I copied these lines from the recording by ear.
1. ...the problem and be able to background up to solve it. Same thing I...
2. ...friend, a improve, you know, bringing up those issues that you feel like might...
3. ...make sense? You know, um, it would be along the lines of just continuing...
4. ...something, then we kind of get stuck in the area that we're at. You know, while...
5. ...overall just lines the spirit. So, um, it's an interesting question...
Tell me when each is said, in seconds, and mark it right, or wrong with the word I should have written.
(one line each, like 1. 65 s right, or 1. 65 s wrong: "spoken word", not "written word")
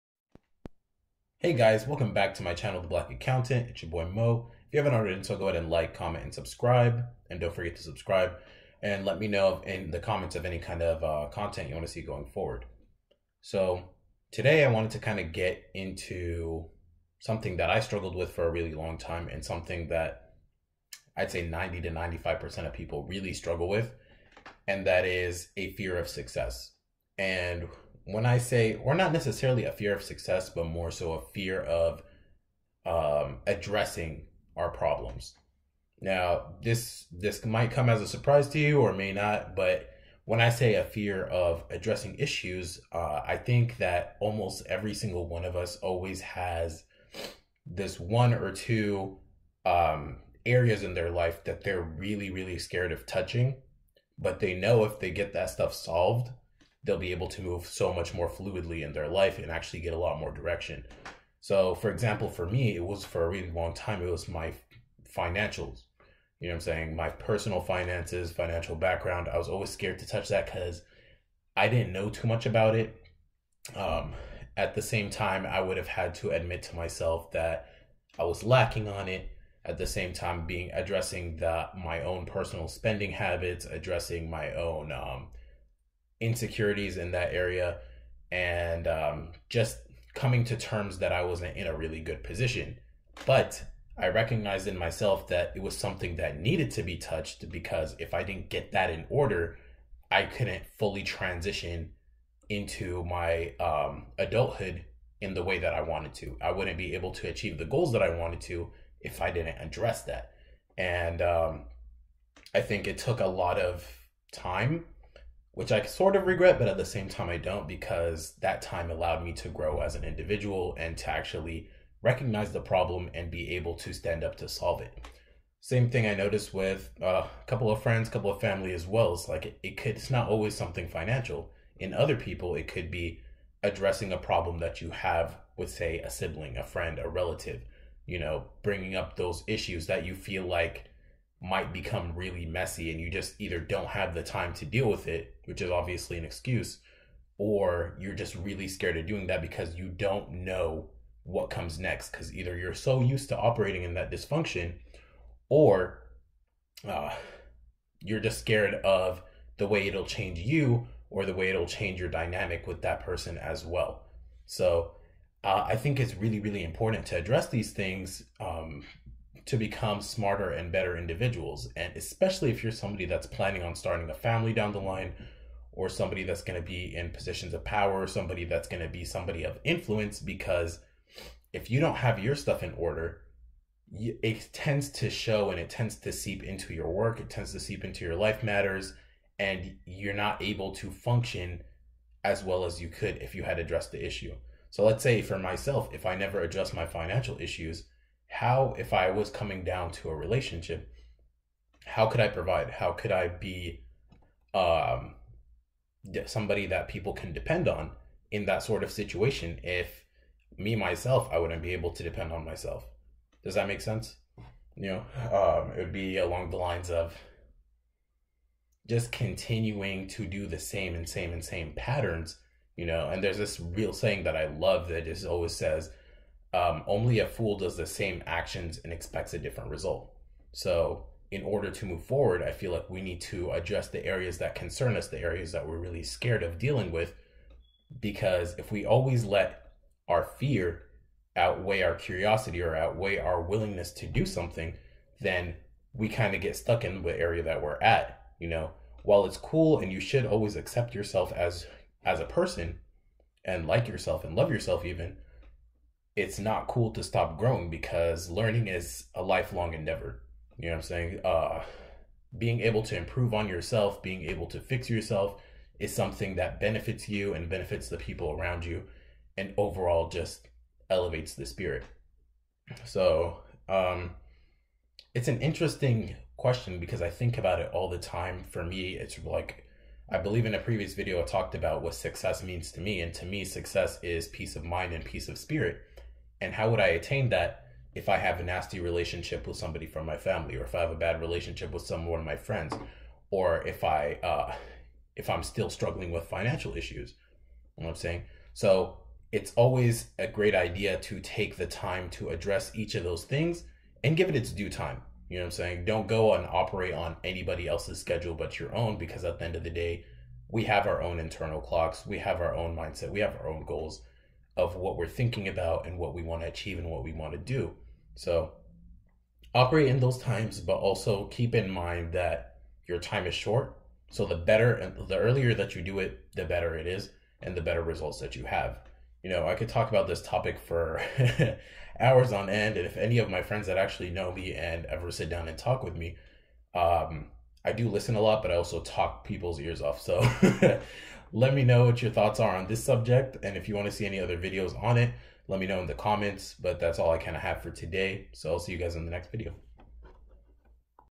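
1. 122 s wrong: "stand", not "background"
2. 136 s wrong: "relative", not "improve"
3. 213 s right
4. 244 s right
5. 269 s wrong: "elevates", not "lines".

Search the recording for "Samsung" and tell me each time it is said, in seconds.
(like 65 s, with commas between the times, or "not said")
not said.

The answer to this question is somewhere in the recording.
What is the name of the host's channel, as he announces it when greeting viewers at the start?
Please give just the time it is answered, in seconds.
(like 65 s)
2 s.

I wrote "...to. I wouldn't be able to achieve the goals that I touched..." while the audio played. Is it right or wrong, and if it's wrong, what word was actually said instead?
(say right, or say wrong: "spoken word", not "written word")
wrong: "wanted", not "touched".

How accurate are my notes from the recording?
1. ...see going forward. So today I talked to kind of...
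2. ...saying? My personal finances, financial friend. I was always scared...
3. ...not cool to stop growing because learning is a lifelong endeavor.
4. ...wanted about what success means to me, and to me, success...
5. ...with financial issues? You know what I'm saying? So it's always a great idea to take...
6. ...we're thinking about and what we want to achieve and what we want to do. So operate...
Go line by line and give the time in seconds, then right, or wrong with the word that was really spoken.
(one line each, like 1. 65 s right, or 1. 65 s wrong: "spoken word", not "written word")
1. 11 s wrong: "wanted", not "talked"
2. 66 s wrong: "background", not "friend"
3. 256 s right
4. 281 s wrong: "talked", not "wanted"
5. 296 s right
6. 314 s right.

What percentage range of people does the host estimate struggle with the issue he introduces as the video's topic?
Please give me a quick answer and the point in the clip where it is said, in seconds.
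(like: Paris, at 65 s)
90 to 95%, at 21 s.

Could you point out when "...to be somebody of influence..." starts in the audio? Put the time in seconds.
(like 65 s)
178 s.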